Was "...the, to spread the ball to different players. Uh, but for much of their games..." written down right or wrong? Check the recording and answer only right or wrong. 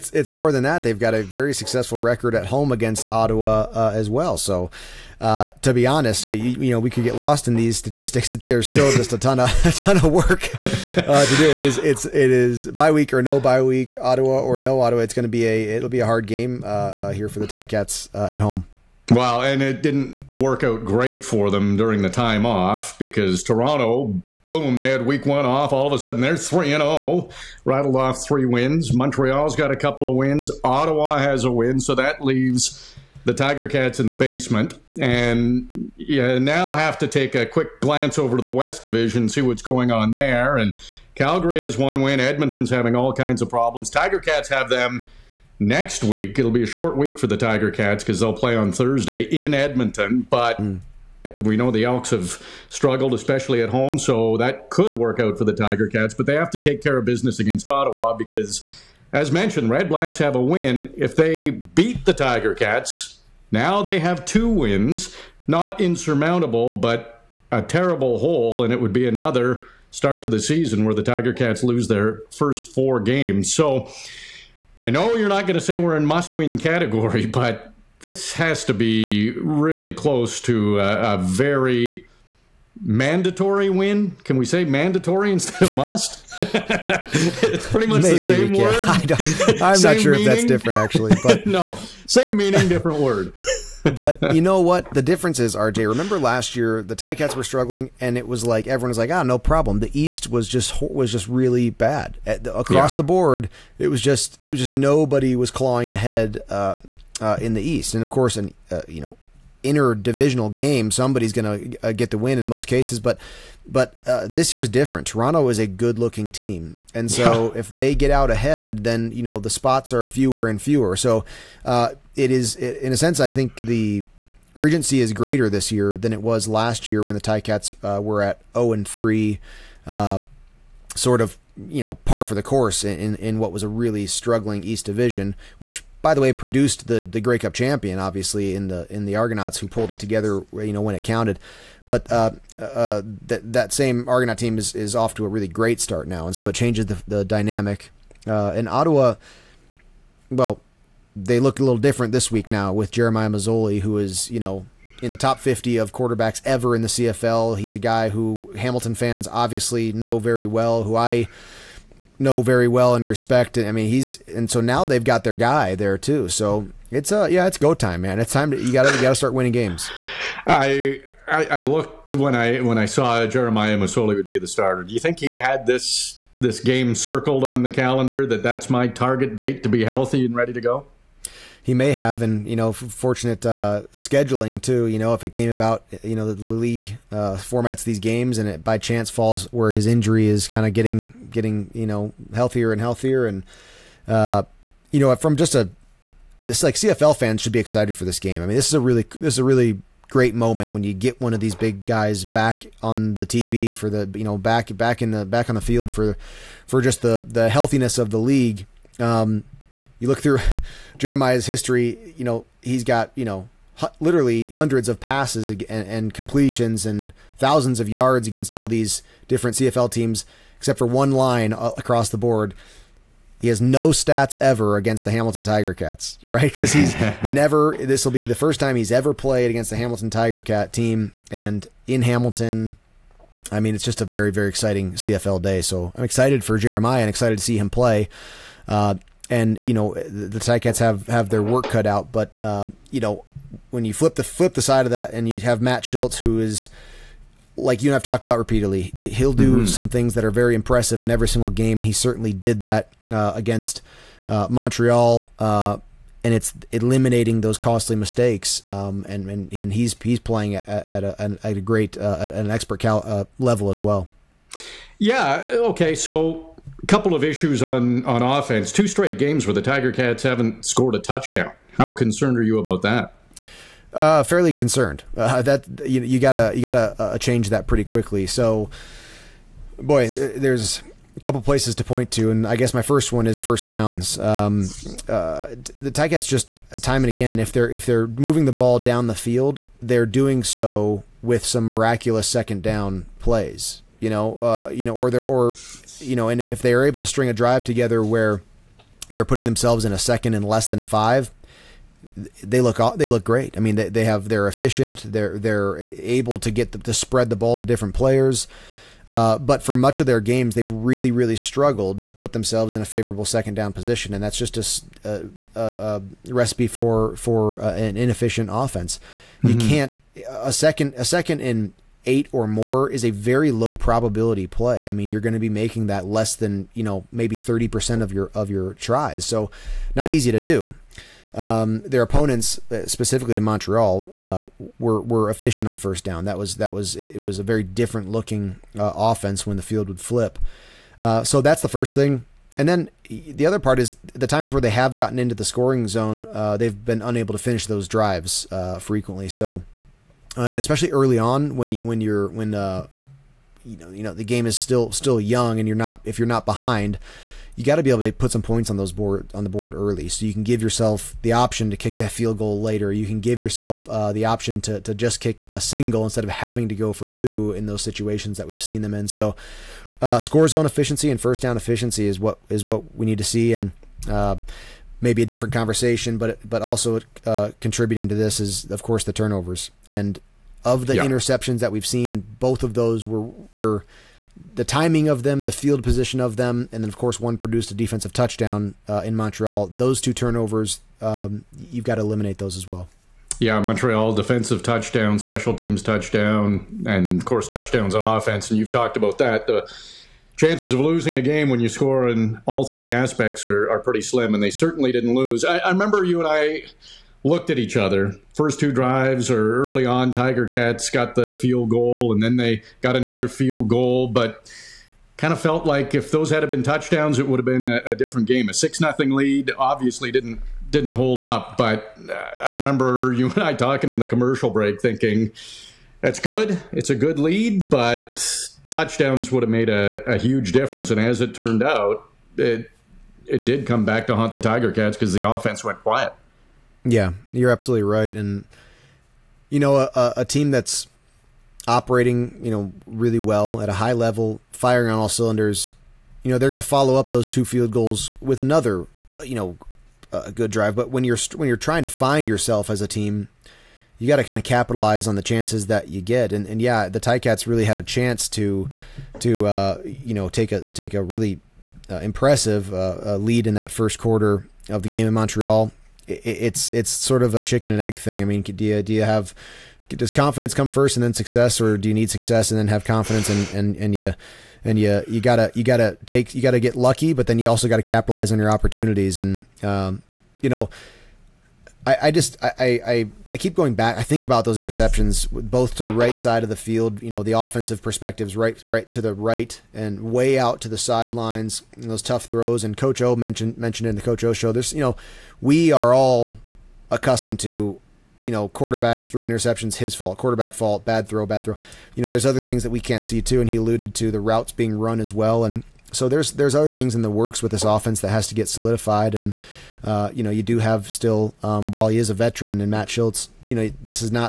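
right.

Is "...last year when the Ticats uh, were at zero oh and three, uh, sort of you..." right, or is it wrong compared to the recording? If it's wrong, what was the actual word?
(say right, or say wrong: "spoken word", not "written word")
right.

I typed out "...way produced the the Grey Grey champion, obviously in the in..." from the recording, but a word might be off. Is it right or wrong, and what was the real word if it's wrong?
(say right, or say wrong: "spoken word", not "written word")
wrong: "Cup", not "Grey".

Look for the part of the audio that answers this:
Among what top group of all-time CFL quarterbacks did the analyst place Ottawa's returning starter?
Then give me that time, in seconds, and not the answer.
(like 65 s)
155 s.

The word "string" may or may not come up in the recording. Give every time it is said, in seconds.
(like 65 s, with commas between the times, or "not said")
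297 s.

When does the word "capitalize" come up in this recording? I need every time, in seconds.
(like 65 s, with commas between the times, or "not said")
454 s, 477 s.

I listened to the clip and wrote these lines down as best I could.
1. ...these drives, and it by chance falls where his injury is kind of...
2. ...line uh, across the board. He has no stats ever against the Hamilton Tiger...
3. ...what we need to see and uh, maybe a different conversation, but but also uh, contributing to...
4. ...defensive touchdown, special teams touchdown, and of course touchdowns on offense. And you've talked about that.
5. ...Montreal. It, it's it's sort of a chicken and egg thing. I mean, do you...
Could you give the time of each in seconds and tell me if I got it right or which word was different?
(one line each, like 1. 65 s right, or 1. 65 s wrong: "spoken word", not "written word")
1. 187 s wrong: "games", not "drives"
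2. 221 s right
3. 372 s right
4. 394 s right
5. 465 s right.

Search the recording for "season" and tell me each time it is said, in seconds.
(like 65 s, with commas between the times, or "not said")
70 s.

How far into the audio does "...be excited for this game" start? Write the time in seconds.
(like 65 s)
197 s.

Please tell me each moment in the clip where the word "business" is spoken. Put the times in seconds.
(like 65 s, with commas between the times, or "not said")
57 s.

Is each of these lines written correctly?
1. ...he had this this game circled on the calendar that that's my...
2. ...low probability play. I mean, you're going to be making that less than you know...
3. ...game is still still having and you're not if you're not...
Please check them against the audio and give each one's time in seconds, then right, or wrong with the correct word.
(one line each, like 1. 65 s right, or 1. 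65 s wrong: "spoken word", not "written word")
1. 175 s right
2. 323 s right
3. 354 s wrong: "young", not "having".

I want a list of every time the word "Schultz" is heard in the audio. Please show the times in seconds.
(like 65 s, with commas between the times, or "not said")
245 s, 512 s.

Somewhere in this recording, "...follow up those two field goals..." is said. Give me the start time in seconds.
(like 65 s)
446 s.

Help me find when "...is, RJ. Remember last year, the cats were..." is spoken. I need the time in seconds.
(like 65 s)
95 s.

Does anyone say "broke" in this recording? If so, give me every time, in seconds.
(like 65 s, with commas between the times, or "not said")
not said.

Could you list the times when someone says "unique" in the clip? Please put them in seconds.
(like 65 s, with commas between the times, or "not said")
not said.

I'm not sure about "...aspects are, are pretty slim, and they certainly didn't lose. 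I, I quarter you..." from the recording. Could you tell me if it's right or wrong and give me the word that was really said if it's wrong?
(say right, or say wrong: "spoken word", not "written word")
wrong: "remember", not "quarter".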